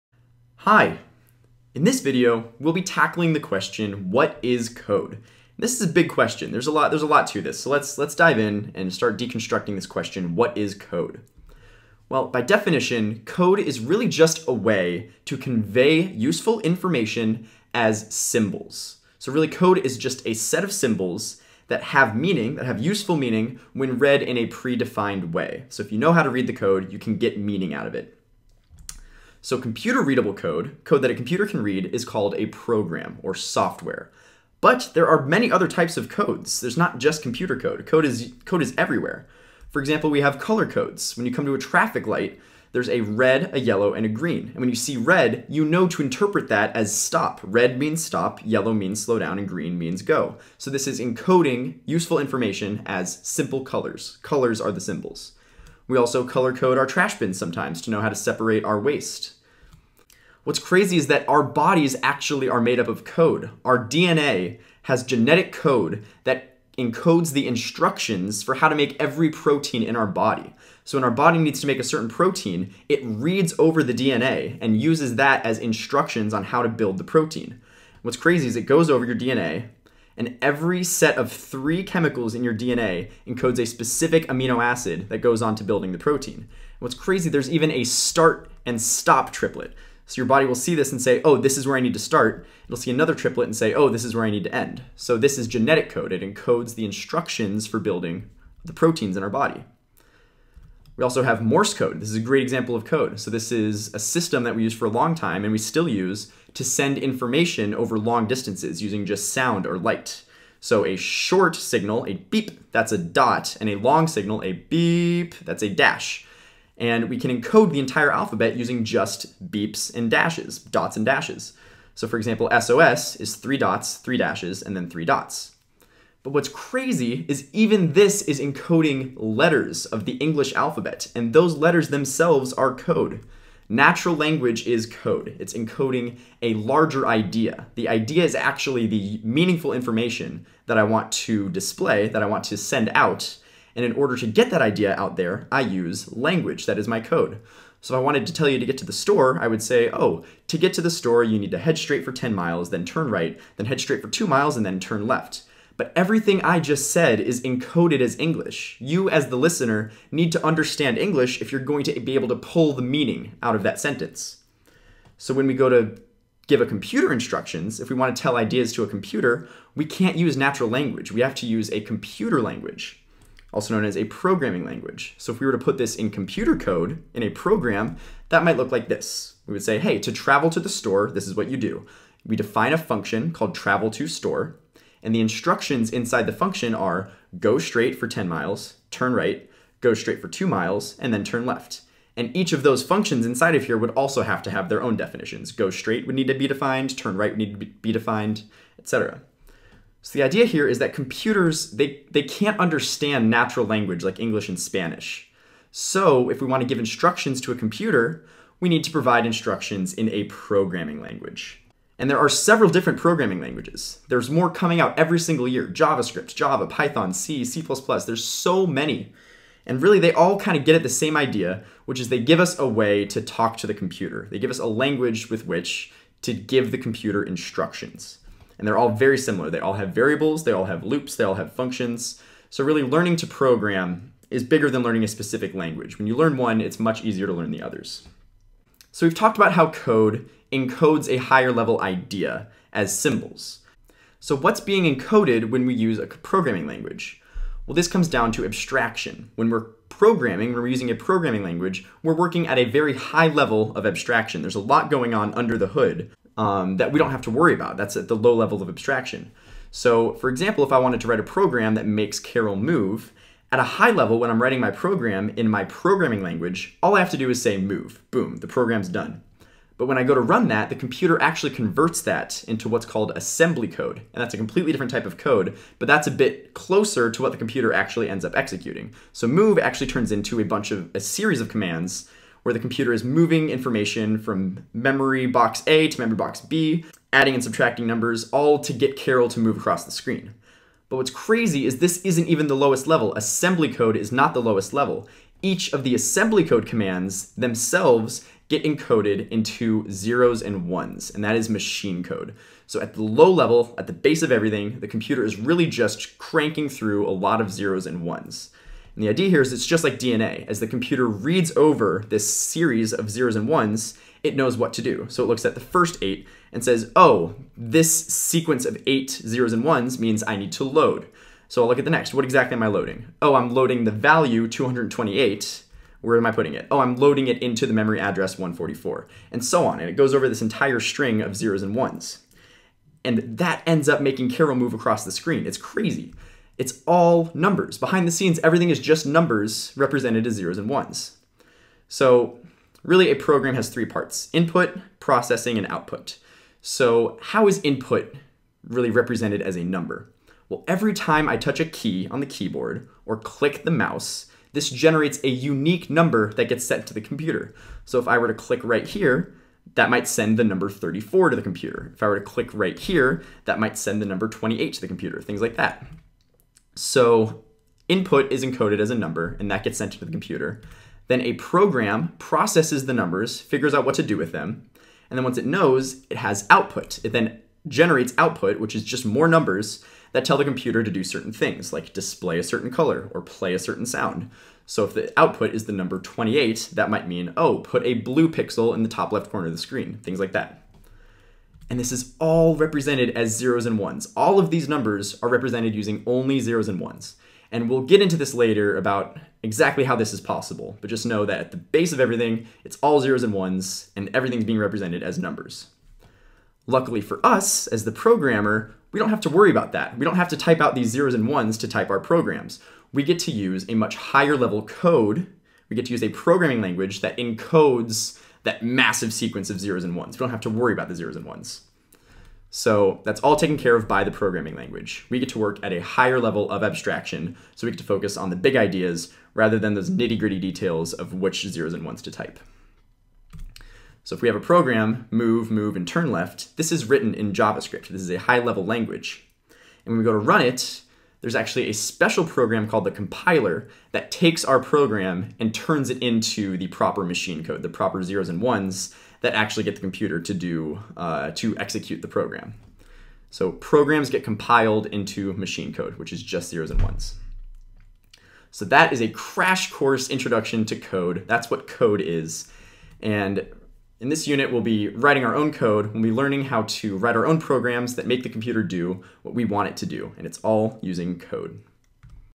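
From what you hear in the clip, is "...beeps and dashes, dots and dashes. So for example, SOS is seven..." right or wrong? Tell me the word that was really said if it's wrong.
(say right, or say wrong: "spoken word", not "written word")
wrong: "three", not "seven".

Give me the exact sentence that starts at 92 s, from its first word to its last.
It'll see another triplet and say, oh, this is where I need to end.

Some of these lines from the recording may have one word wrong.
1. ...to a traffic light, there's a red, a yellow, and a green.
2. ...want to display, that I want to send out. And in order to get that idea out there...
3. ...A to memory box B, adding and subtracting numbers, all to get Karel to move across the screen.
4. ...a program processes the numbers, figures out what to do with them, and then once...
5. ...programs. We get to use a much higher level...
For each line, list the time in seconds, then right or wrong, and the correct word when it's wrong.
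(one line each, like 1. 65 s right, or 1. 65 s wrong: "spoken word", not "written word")
1. 41 s right
2. 140 s right
3. 285 s right
4. 371 s right
5. 411 s right.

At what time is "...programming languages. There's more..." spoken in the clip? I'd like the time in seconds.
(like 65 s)
212 s.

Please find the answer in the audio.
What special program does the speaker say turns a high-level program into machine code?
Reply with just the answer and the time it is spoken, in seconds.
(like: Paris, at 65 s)
the compiler, at 442 s.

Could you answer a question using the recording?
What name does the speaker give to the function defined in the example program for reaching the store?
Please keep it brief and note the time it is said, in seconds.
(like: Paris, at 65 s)
travel to store, at 183 s.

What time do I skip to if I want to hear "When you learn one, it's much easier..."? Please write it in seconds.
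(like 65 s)
235 s.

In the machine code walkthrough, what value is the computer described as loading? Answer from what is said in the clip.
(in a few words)
228.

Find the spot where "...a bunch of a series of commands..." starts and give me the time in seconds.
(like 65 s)
280 s.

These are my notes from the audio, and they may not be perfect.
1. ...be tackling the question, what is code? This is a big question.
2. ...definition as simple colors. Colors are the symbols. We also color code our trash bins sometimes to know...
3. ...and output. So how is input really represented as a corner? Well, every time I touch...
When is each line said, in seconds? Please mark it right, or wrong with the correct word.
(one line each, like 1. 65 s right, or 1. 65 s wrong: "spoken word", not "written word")
1. 2 s right
2. 52 s wrong: "information", not "definition"
3. 345 s wrong: "number", not "corner".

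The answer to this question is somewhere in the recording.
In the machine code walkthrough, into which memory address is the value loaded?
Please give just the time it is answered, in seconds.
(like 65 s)
328 s.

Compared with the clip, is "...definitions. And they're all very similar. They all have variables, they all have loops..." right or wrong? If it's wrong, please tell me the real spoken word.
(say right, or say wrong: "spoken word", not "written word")
wrong: "instructions", not "definitions".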